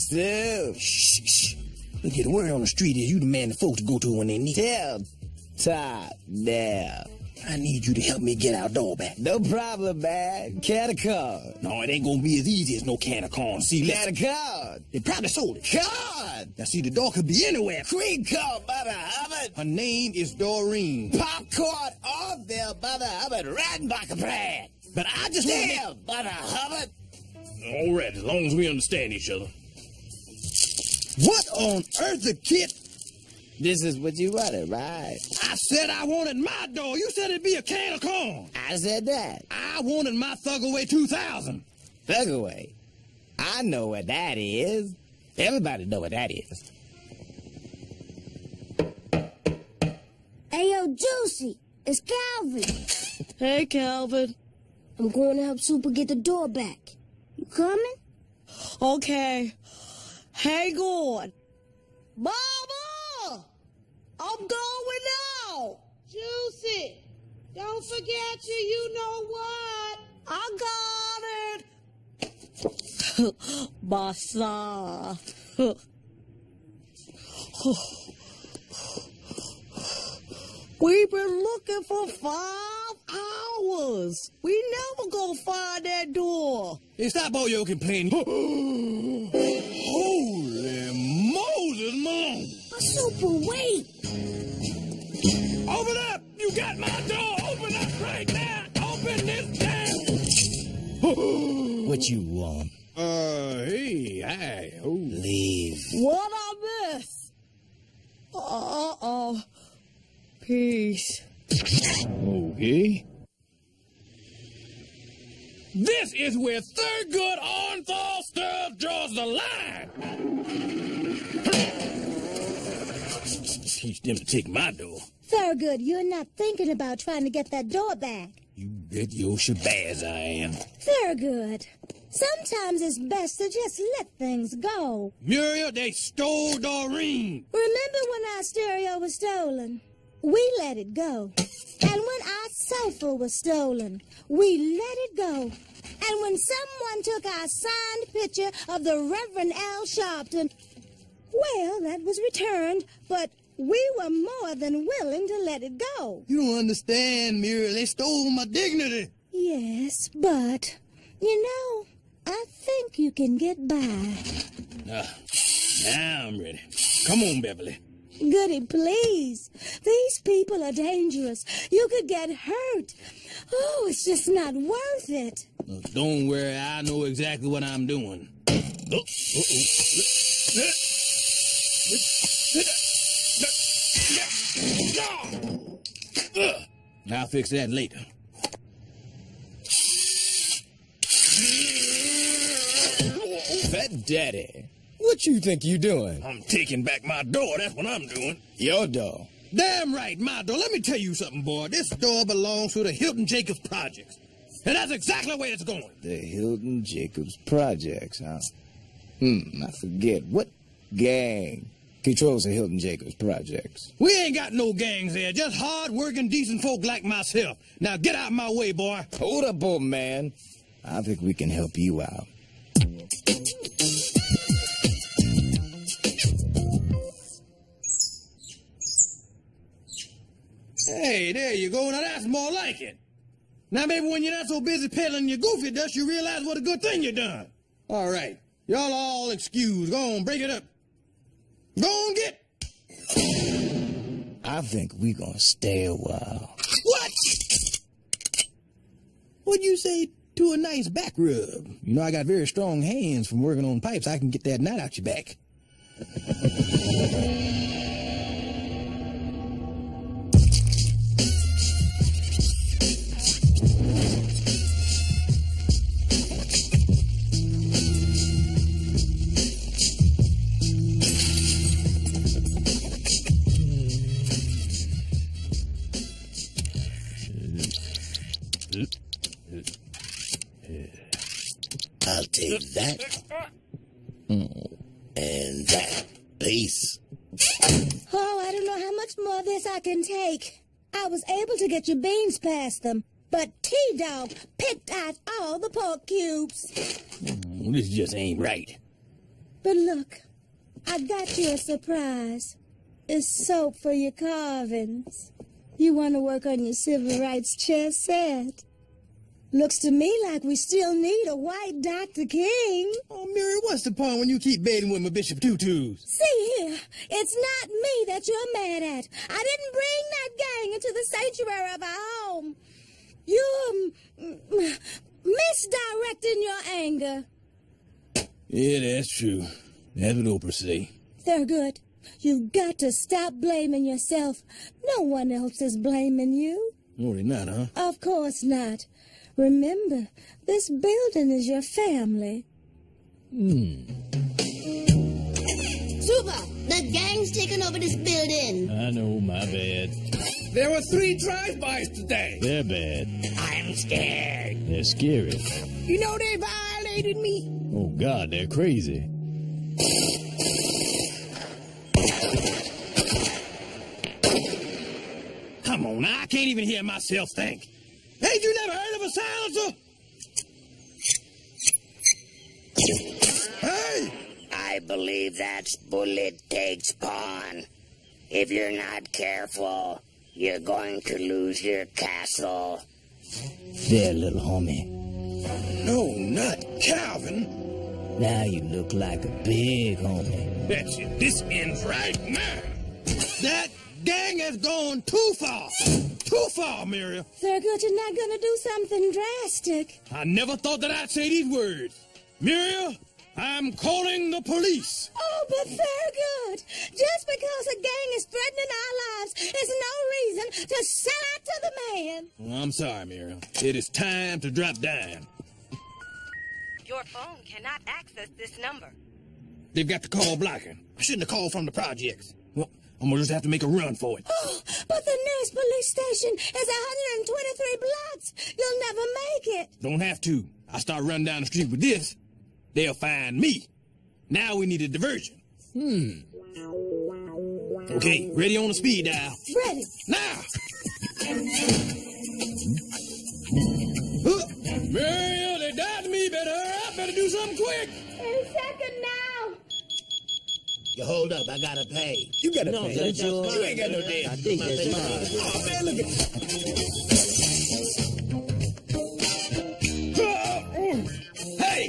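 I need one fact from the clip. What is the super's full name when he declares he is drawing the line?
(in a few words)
Thurgood Orenthal Stubbs.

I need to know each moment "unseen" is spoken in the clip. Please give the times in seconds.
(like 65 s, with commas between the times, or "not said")
not said.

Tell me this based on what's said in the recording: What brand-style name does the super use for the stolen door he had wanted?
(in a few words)
Thugaway 2000.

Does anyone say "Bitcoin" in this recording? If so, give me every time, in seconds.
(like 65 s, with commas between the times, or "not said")
not said.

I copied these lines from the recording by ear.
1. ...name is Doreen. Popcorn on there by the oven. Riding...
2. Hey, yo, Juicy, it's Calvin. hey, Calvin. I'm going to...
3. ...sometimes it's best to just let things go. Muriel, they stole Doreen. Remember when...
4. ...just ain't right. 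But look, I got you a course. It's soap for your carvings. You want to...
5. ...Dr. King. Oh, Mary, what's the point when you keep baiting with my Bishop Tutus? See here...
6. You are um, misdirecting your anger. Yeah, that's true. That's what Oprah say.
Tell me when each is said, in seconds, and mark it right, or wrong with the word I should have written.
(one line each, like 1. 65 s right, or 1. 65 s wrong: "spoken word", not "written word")
1. 19 s right
2. 50 s right
3. 132 s right
4. 297 s wrong: "surprise", not "course"
5. 311 s right
6. 323 s right.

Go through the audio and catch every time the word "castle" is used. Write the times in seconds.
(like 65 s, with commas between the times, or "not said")
381 s.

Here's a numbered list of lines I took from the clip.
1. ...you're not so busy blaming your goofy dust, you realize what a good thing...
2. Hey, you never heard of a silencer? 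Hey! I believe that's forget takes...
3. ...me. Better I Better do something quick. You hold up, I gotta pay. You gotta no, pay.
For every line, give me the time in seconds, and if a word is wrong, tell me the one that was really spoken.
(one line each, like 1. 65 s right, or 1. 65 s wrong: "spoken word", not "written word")
1. 234 s wrong: "peddling", not "blaming"
2. 368 s wrong: "bullet", not "forget"
3. 446 s right.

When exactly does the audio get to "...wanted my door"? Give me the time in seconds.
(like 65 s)
36 s.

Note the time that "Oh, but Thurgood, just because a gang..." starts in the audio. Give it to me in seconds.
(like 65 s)
405 s.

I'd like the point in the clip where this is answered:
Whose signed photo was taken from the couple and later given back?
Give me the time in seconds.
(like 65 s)
149 s.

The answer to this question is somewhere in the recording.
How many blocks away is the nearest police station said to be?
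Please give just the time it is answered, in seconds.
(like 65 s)
426 s.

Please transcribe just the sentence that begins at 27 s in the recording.
All right, as long as we understand each other.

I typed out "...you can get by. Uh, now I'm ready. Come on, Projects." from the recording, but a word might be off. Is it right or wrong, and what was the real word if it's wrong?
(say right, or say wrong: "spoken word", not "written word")
wrong: "Beverly", not "Projects".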